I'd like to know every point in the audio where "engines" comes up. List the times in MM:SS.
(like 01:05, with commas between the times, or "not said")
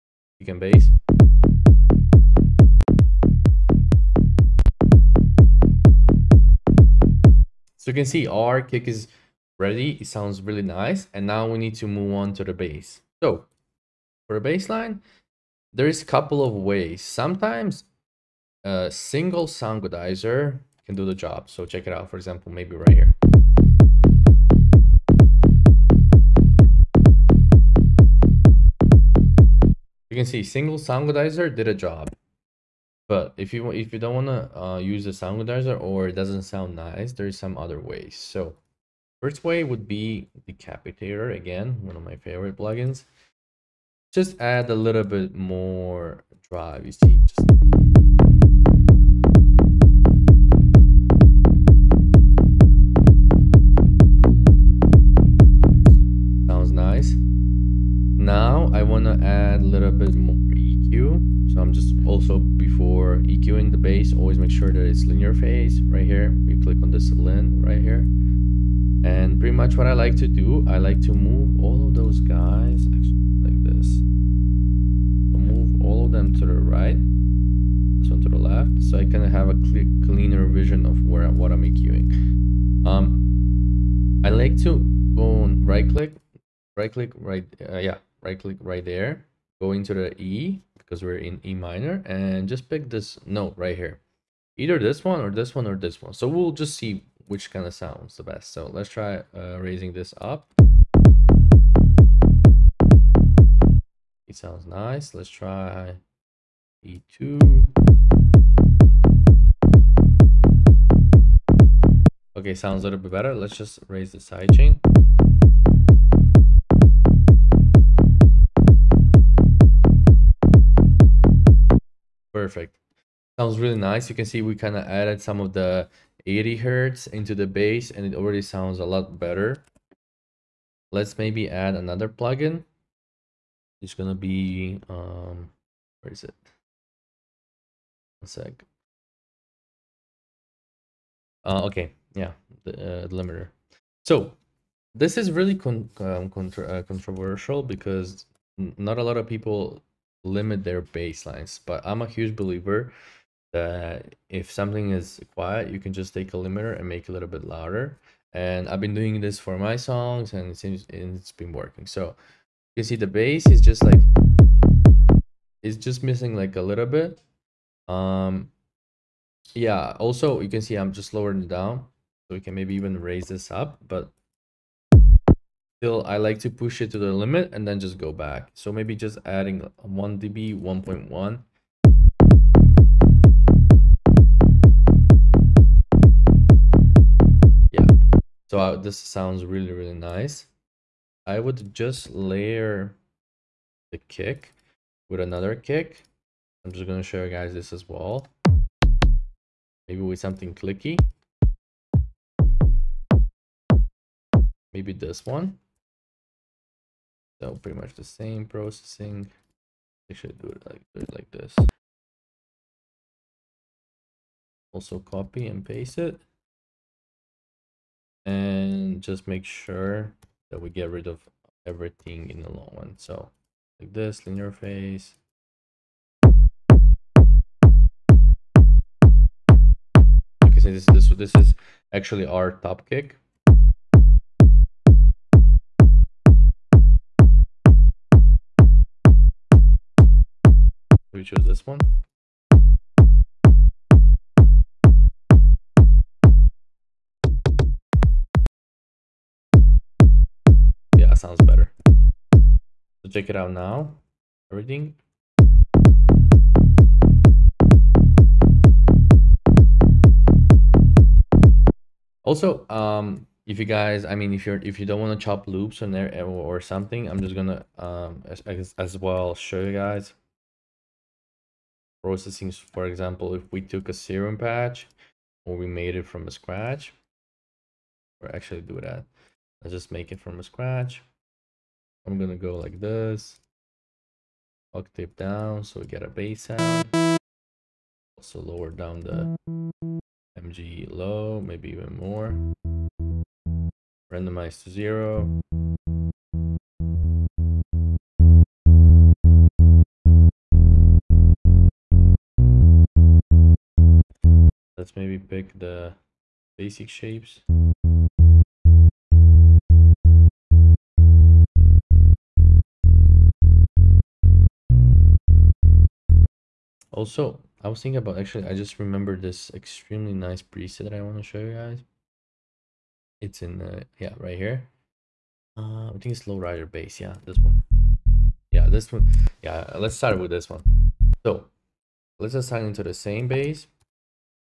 not said.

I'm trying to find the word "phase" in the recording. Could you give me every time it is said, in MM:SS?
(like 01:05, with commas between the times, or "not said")
01:05, 03:44.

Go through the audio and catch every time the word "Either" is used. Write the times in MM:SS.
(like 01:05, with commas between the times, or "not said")
01:34.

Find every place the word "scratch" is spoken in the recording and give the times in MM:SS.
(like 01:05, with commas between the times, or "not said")
04:36, 04:40.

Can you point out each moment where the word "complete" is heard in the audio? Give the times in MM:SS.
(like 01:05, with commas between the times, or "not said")
not said.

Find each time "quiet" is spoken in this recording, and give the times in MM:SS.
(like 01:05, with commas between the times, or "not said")
02:35.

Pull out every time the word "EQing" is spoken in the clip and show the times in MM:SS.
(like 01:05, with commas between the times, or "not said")
01:03, 01:21.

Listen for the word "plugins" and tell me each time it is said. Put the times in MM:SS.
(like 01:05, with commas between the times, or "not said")
00:42, 02:12.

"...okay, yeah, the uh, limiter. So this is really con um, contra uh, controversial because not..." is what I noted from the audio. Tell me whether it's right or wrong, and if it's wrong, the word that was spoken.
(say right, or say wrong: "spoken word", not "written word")
right.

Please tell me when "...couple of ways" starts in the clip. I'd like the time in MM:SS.
00:16.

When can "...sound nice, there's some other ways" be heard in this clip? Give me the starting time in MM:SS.
00:36.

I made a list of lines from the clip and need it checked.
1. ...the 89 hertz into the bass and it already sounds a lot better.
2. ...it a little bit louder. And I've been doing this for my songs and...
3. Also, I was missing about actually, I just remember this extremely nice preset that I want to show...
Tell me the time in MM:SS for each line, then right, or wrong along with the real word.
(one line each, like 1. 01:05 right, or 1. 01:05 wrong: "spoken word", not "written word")
1. 02:05 wrong: "80", not "89"
2. 02:37 right
3. 05:16 wrong: "thinking", not "missing".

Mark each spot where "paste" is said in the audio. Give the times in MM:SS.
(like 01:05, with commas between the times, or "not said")
03:35.